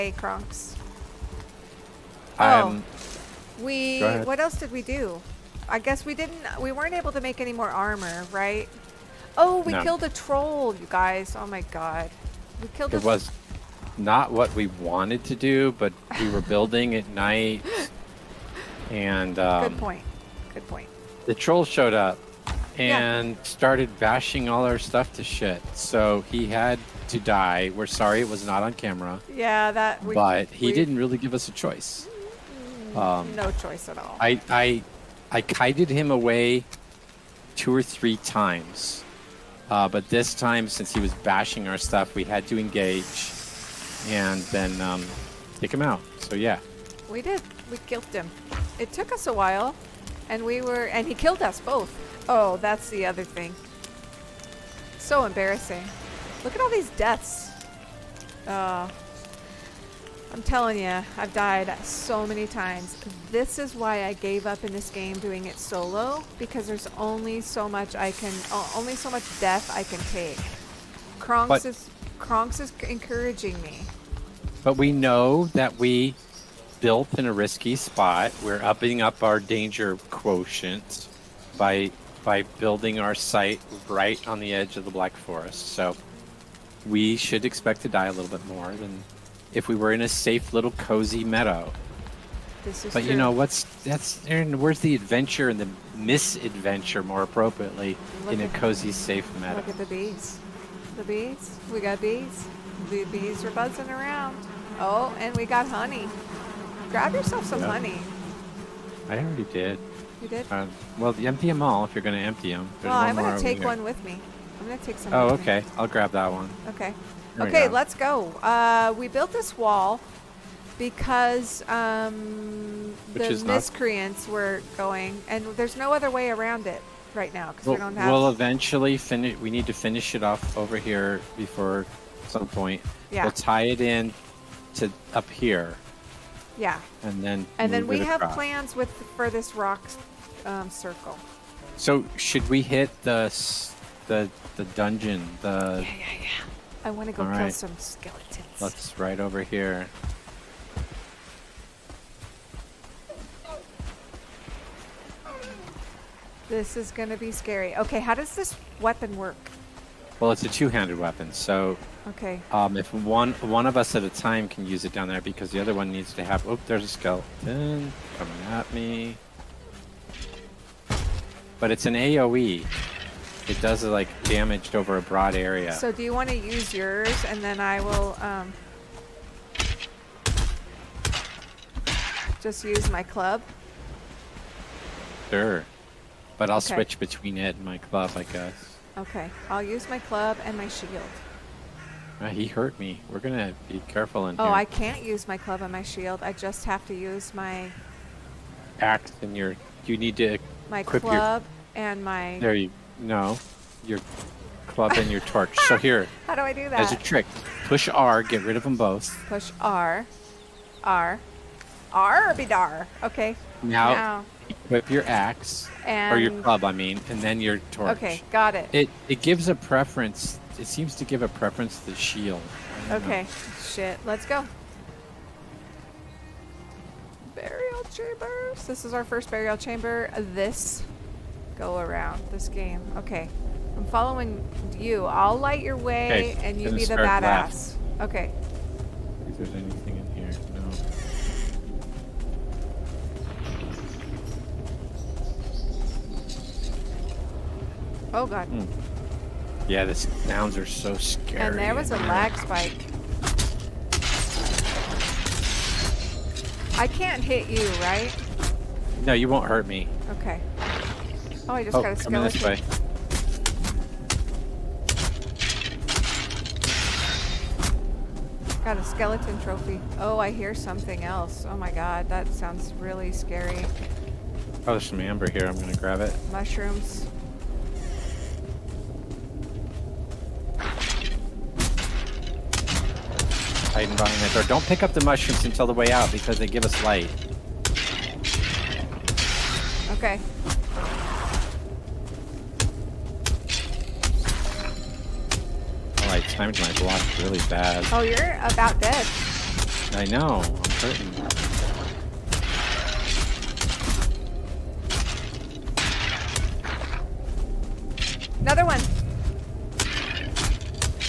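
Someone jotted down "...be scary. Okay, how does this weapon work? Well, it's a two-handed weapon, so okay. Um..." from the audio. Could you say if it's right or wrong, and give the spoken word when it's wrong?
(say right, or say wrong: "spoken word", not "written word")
right.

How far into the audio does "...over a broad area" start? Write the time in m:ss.
2:54.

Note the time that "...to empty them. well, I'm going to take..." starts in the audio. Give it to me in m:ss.
1:52.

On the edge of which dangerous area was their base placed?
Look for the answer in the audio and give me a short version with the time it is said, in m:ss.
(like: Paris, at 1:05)
Black Forest, at 1:24.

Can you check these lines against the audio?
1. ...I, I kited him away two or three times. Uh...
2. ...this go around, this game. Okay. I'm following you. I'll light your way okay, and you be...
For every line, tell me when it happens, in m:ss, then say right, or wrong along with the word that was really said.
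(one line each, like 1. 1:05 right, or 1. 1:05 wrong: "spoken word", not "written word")
1. 0:34 right
2. 3:50 right.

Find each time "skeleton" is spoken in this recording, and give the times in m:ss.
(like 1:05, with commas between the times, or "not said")
2:27, 2:46, 4:21, 4:28.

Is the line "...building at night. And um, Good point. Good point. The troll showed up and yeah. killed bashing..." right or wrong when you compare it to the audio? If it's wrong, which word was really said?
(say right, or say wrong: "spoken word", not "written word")
wrong: "started", not "killed".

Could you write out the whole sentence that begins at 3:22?
There you no, your club and your torch.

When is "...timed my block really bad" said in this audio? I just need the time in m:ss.
4:56.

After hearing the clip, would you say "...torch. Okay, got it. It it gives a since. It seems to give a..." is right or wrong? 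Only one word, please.
wrong.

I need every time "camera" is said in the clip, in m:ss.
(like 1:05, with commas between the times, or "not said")
0:28.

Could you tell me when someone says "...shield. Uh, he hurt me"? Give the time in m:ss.
3:10.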